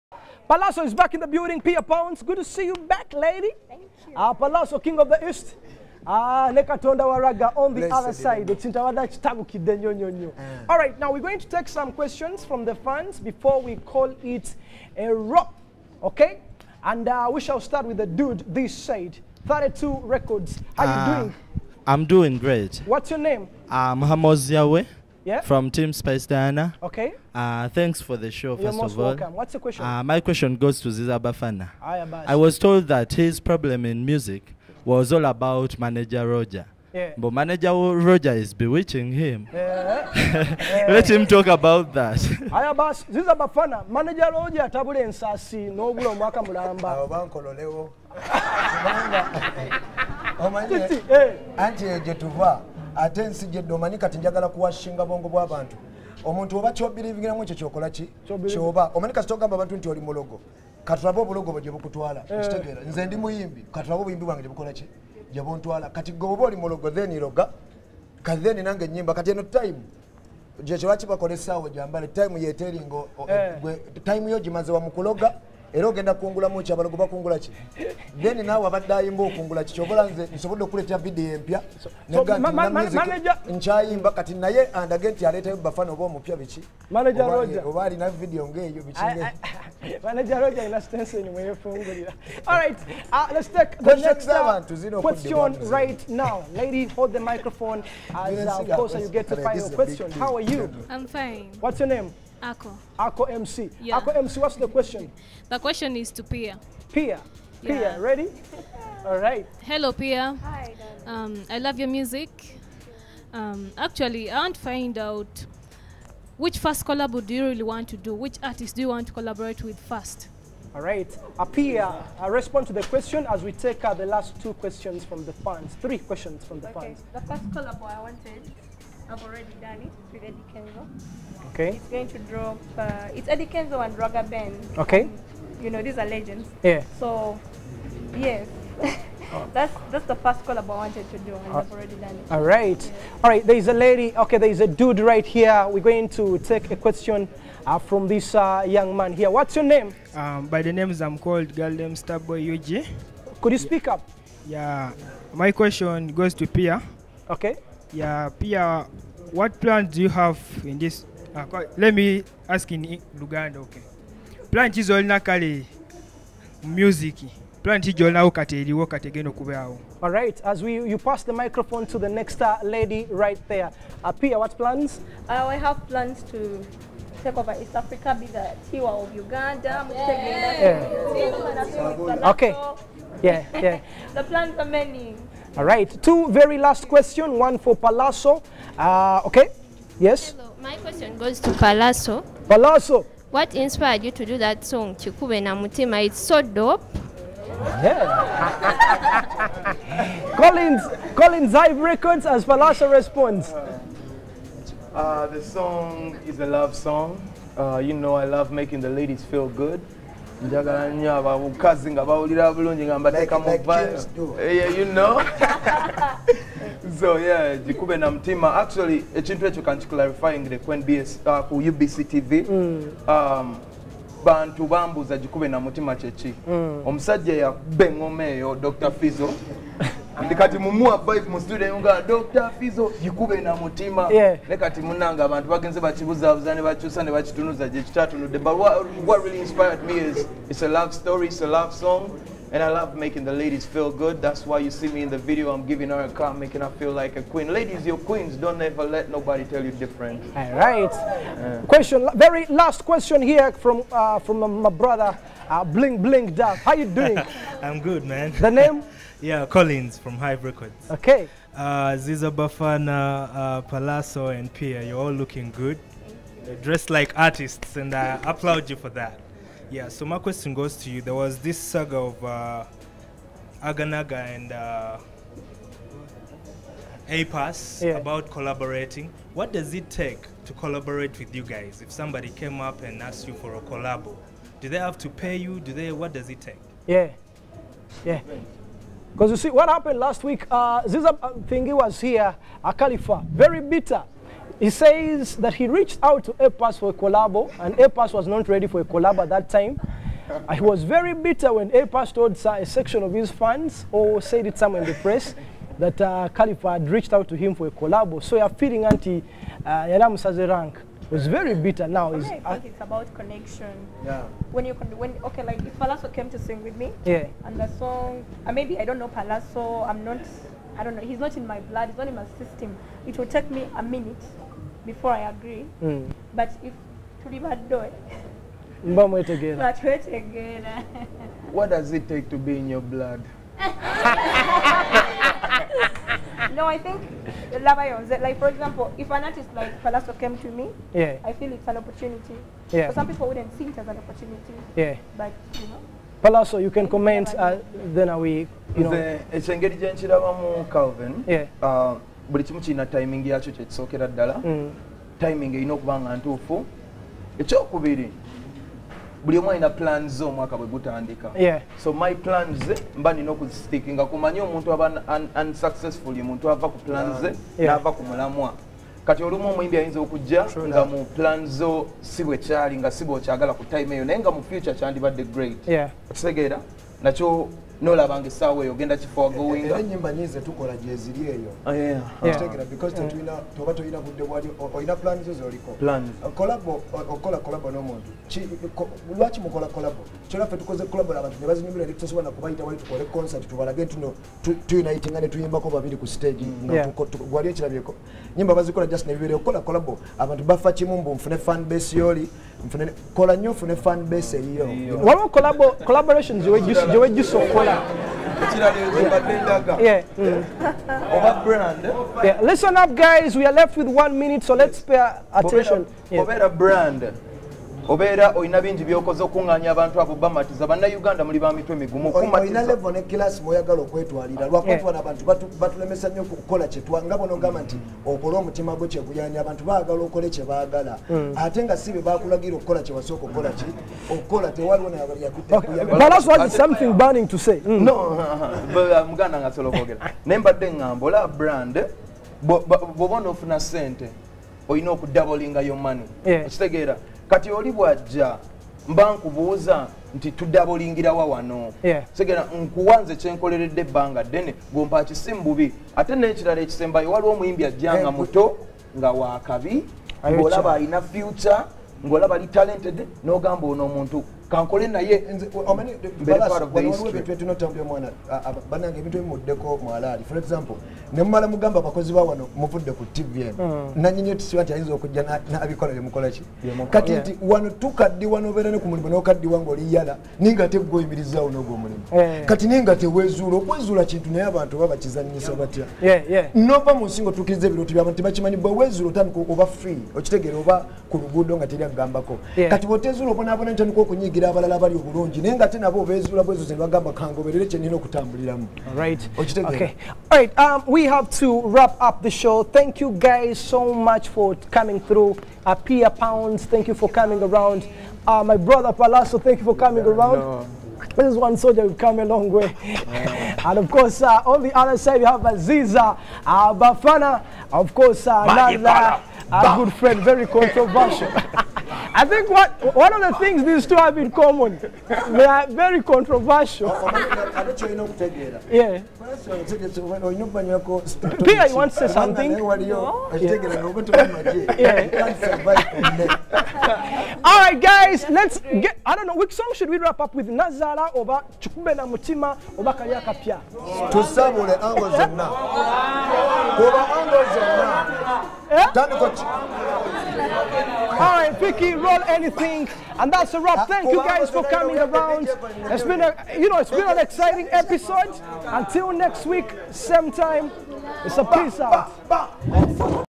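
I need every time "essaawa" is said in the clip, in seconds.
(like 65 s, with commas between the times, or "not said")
71 s, 378 s.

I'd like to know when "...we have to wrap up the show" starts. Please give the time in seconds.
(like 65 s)
500 s.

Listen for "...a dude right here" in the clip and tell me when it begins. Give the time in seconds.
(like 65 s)
144 s.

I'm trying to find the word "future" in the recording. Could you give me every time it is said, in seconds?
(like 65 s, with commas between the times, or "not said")
374 s, 461 s.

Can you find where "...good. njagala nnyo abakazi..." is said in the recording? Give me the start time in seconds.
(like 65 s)
209 s.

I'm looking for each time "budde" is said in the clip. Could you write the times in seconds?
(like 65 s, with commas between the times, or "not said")
383 s.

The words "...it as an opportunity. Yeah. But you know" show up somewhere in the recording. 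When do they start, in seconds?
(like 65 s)
343 s.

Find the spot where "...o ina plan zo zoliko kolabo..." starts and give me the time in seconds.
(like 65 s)
384 s.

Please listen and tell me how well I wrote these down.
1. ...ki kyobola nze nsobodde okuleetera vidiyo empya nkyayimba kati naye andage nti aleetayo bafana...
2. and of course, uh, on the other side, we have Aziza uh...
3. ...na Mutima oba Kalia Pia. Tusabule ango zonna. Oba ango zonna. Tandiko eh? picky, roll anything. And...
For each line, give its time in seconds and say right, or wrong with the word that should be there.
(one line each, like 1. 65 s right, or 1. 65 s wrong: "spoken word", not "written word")
1. 79 s right
2. 513 s right
3. 541 s right.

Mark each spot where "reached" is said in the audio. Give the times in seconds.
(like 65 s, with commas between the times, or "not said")
295 s, 306 s.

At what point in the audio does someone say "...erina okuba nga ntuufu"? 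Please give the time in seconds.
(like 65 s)
355 s.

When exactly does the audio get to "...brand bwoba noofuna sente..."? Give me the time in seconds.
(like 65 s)
441 s.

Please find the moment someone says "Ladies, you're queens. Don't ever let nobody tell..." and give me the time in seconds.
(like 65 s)
247 s.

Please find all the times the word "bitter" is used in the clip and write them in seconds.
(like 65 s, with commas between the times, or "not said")
293 s, 301 s, 311 s.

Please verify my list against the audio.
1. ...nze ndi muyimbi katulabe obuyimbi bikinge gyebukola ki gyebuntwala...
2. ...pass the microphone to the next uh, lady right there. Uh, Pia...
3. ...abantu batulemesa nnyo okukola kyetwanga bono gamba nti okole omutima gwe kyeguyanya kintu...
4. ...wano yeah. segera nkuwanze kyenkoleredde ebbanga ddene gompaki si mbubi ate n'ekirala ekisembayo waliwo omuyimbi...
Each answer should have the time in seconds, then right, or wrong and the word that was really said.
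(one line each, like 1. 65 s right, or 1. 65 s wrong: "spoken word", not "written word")
1. 62 s wrong: "bwange", not "bikinge"
2. 170 s right
3. 425 s wrong: "abantu", not "kintu"
4. 451 s right.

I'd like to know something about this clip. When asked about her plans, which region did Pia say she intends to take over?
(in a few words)
East Africa.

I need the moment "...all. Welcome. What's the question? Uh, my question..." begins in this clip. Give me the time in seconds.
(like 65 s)
28 s.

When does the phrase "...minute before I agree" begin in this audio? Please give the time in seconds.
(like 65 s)
323 s.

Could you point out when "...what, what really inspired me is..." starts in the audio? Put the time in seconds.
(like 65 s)
238 s.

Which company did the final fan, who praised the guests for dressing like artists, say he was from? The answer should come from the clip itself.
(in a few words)
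Hive Records.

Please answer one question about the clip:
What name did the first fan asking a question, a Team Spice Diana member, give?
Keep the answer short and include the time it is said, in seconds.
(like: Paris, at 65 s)
Muhammad Ziawe, at 23 s.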